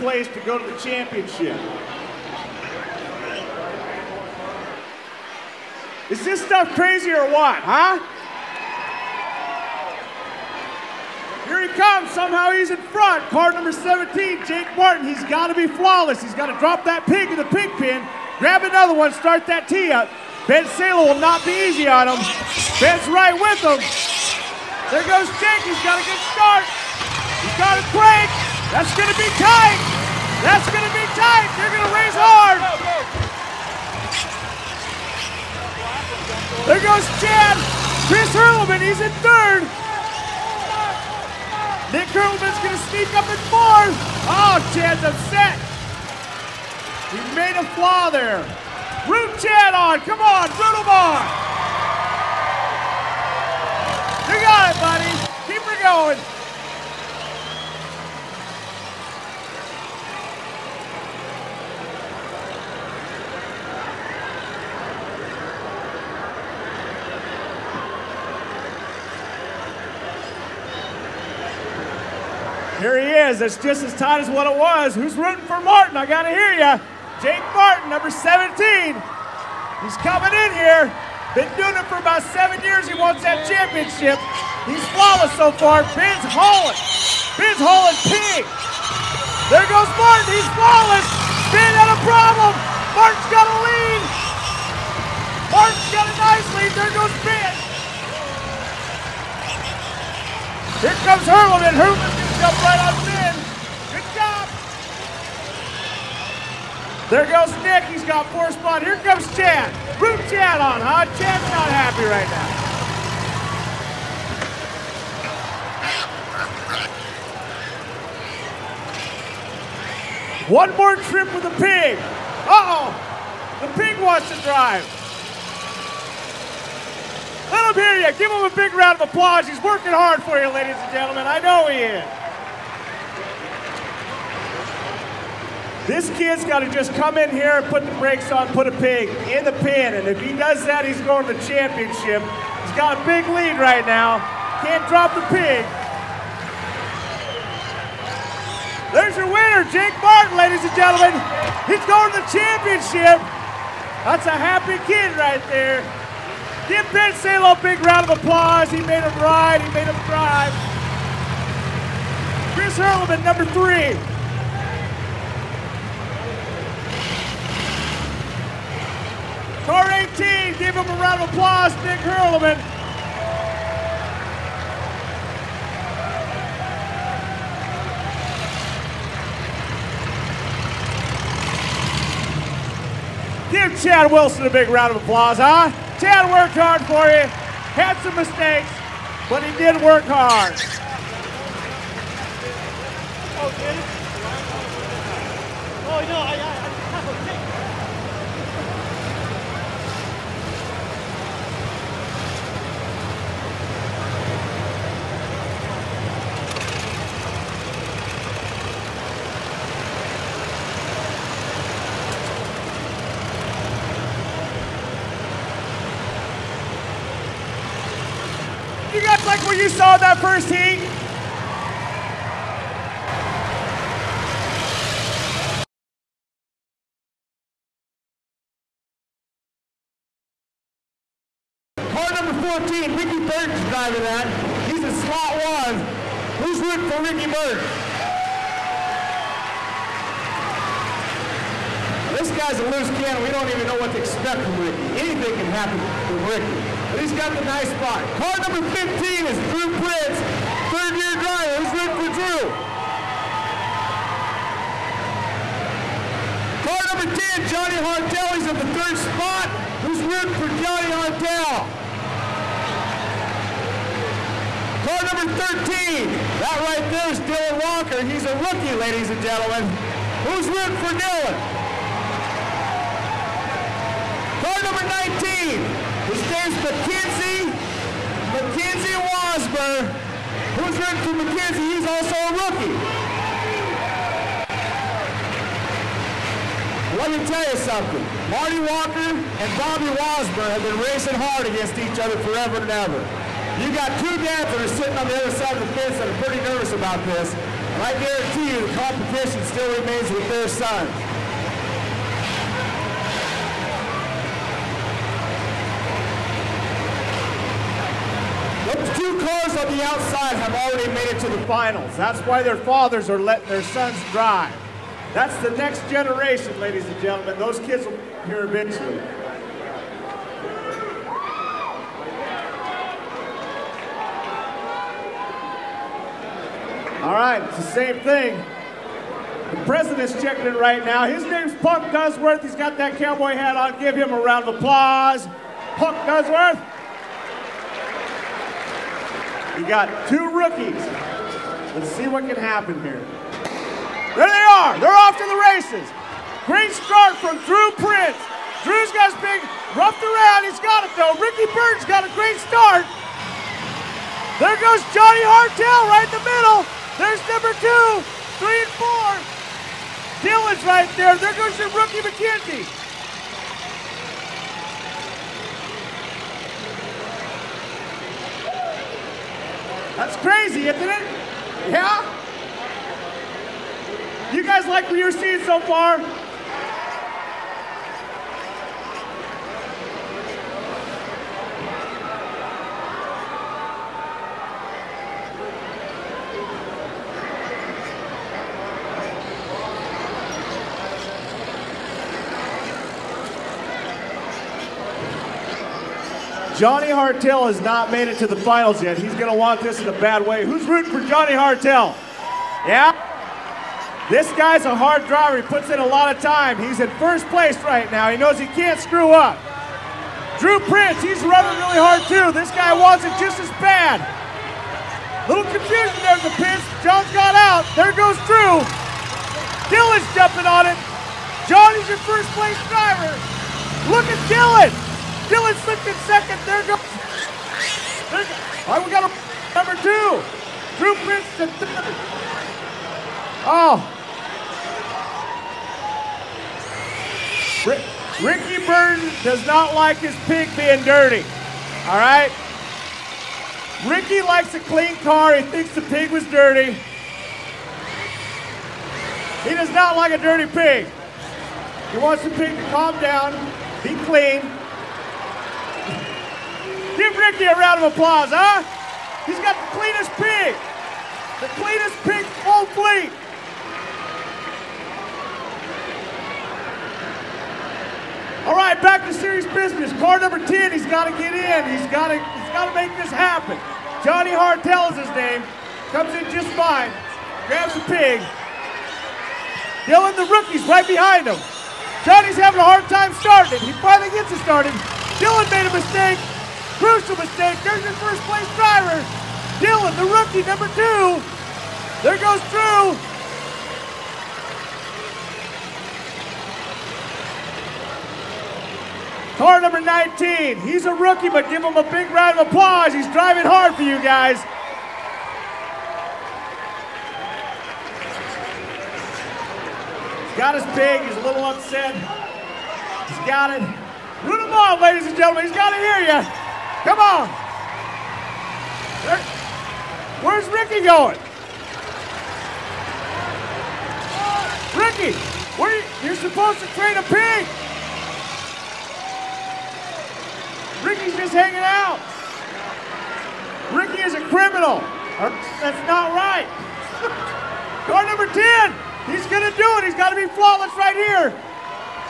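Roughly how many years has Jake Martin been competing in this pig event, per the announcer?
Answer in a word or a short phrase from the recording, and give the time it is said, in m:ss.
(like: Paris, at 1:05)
7, at 1:21.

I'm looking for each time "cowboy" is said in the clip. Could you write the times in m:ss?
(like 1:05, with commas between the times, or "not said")
5:32.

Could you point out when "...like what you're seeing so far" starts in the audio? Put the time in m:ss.
6:14.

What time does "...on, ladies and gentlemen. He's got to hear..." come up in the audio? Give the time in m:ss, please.
8:34.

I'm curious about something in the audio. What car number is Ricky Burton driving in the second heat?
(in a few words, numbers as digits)
14.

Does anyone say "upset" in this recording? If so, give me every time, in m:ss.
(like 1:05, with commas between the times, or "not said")
0:45, 8:31.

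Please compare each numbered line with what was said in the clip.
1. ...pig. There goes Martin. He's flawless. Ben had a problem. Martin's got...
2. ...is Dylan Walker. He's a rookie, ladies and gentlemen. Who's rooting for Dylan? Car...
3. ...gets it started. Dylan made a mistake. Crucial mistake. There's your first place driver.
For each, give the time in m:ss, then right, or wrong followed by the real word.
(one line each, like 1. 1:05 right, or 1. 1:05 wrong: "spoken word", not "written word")
1. 1:28 right
2. 4:27 right
3. 8:04 right.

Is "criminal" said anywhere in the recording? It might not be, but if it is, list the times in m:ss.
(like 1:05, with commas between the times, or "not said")
8:54.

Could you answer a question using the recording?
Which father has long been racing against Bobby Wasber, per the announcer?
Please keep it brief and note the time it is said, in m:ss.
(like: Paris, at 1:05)
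Marty Walker, at 4:48.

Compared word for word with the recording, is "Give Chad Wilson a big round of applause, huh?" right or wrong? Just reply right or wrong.
right.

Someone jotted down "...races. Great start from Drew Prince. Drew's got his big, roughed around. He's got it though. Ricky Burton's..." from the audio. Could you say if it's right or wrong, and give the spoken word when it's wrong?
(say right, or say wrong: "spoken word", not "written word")
right.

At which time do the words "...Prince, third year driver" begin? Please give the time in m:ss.
4:09.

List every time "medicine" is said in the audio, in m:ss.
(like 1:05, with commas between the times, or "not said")
not said.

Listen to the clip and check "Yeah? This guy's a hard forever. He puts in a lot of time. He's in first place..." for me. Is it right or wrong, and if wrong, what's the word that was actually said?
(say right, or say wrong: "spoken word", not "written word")
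wrong: "driver", not "forever".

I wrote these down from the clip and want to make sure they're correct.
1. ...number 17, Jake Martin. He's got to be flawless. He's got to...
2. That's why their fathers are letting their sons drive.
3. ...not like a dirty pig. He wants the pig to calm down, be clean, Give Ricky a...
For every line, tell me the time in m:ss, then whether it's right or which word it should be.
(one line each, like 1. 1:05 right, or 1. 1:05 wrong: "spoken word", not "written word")
1. 0:13 right
2. 5:11 right
3. 7:29 right.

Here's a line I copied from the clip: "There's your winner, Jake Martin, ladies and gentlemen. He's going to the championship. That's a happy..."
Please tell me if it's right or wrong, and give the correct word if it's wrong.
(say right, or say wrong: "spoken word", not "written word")
right.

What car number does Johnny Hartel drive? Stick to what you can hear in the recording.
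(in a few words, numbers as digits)
10.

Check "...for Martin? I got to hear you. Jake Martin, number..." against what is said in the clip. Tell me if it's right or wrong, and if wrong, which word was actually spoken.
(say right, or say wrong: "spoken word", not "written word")
right.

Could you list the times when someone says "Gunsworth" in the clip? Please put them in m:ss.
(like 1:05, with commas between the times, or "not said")
5:31, 5:36.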